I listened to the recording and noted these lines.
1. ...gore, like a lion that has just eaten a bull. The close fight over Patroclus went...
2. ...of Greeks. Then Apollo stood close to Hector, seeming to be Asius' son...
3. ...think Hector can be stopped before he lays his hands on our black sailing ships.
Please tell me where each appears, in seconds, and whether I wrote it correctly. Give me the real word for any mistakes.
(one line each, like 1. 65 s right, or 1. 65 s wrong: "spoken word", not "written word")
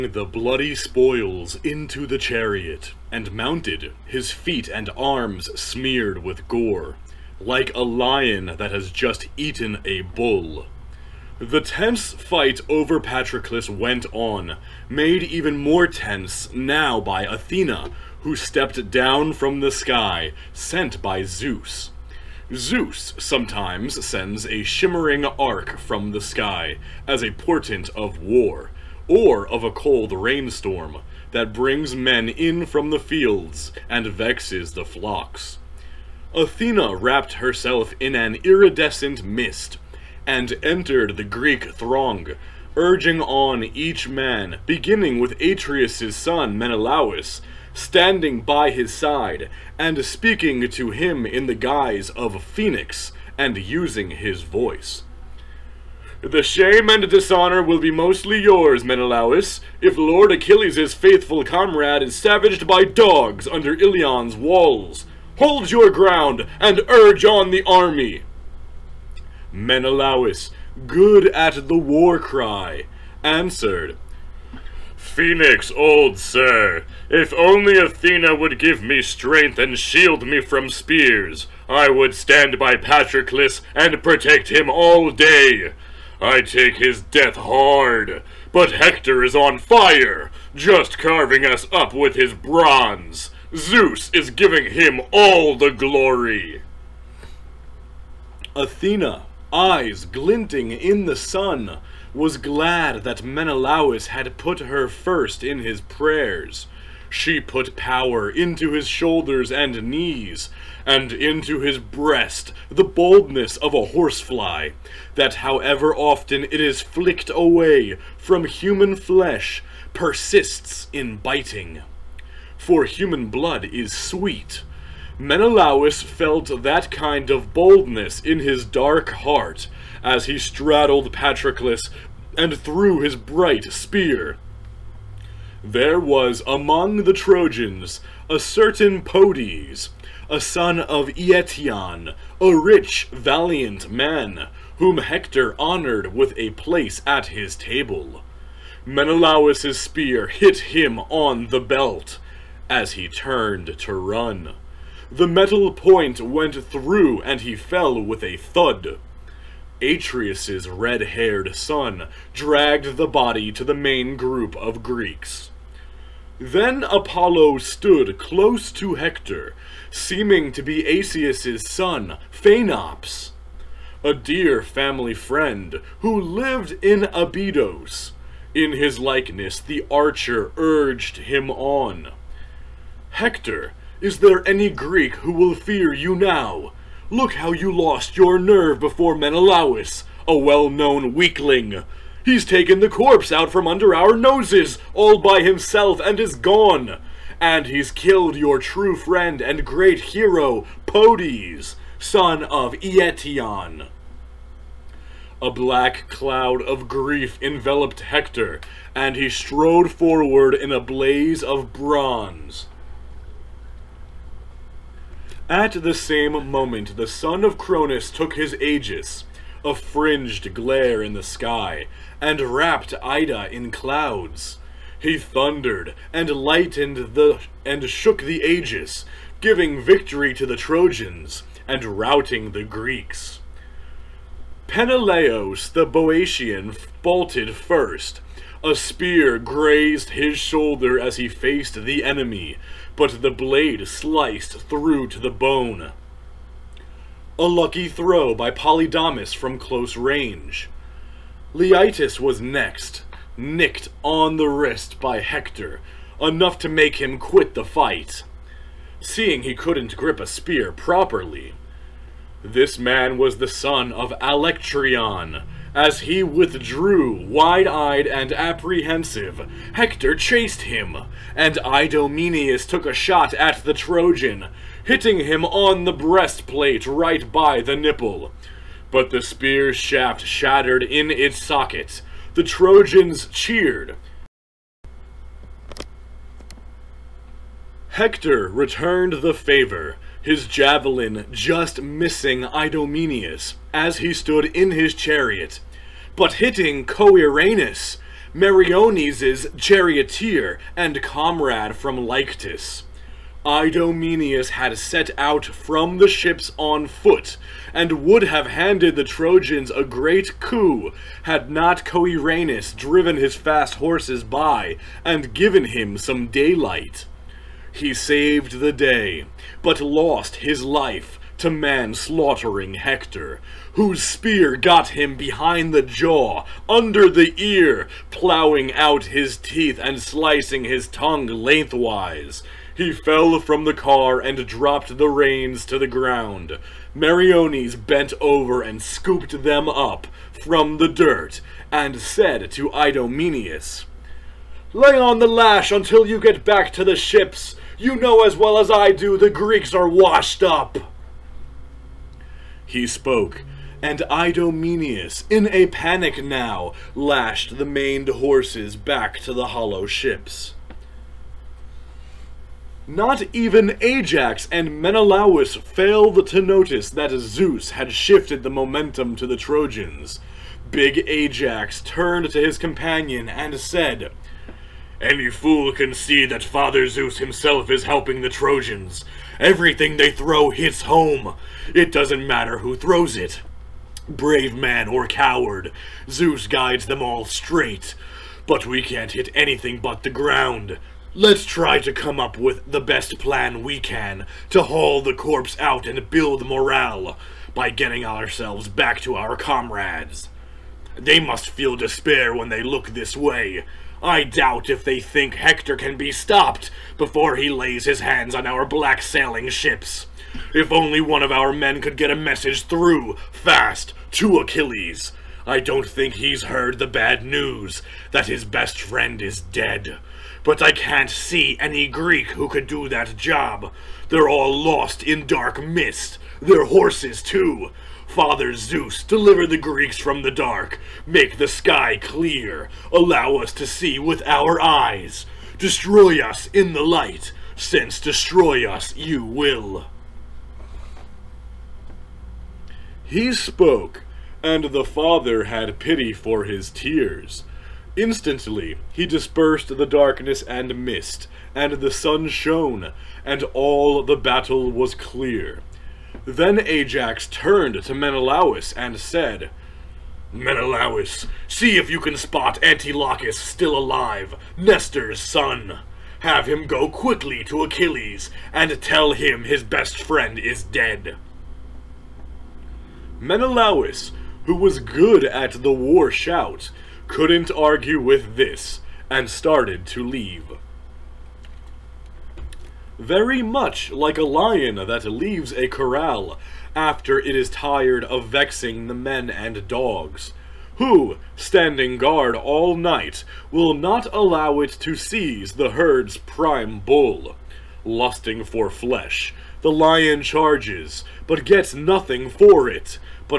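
1. 6 s wrong: "tense", not "close"
2. 164 s right
3. 405 s right.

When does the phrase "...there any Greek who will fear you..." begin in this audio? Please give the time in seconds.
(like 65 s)
184 s.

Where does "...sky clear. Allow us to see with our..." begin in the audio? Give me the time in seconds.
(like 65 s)
431 s.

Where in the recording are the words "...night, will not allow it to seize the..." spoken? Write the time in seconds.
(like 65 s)
492 s.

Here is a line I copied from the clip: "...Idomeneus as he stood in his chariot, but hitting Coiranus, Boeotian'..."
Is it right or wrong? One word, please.
wrong.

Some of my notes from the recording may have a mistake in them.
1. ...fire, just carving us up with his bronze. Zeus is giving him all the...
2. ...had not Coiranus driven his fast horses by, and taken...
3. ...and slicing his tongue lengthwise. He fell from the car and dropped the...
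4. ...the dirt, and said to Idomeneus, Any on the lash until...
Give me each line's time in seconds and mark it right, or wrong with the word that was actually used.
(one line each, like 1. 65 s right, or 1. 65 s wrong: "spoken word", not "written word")
1. 89 s right
2. 311 s wrong: "given", not "taken"
3. 329 s right
4. 340 s wrong: "Lay", not "Any".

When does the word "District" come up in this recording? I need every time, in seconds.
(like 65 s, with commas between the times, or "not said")
not said.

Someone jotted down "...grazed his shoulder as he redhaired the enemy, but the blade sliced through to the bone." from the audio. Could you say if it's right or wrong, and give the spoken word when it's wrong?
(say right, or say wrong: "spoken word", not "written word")
wrong: "faced", not "redhaired".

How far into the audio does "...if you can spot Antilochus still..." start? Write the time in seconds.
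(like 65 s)
461 s.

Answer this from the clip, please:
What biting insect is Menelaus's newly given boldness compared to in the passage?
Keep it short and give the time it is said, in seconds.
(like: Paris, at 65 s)
horsefly, at 113 s.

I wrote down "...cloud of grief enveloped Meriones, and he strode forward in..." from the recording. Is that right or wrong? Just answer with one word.
wrong.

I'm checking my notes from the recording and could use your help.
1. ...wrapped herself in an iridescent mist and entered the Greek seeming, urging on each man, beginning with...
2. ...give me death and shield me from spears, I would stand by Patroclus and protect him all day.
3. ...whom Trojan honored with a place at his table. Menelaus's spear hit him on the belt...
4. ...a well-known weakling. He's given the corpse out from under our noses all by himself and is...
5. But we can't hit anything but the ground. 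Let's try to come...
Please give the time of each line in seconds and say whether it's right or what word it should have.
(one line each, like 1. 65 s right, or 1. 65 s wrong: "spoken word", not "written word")
1. 36 s wrong: "throng", not "seeming"
2. 78 s wrong: "strength", not "death"
3. 144 s wrong: "Hector", not "Trojan"
4. 190 s wrong: "taken", not "given"
5. 388 s right.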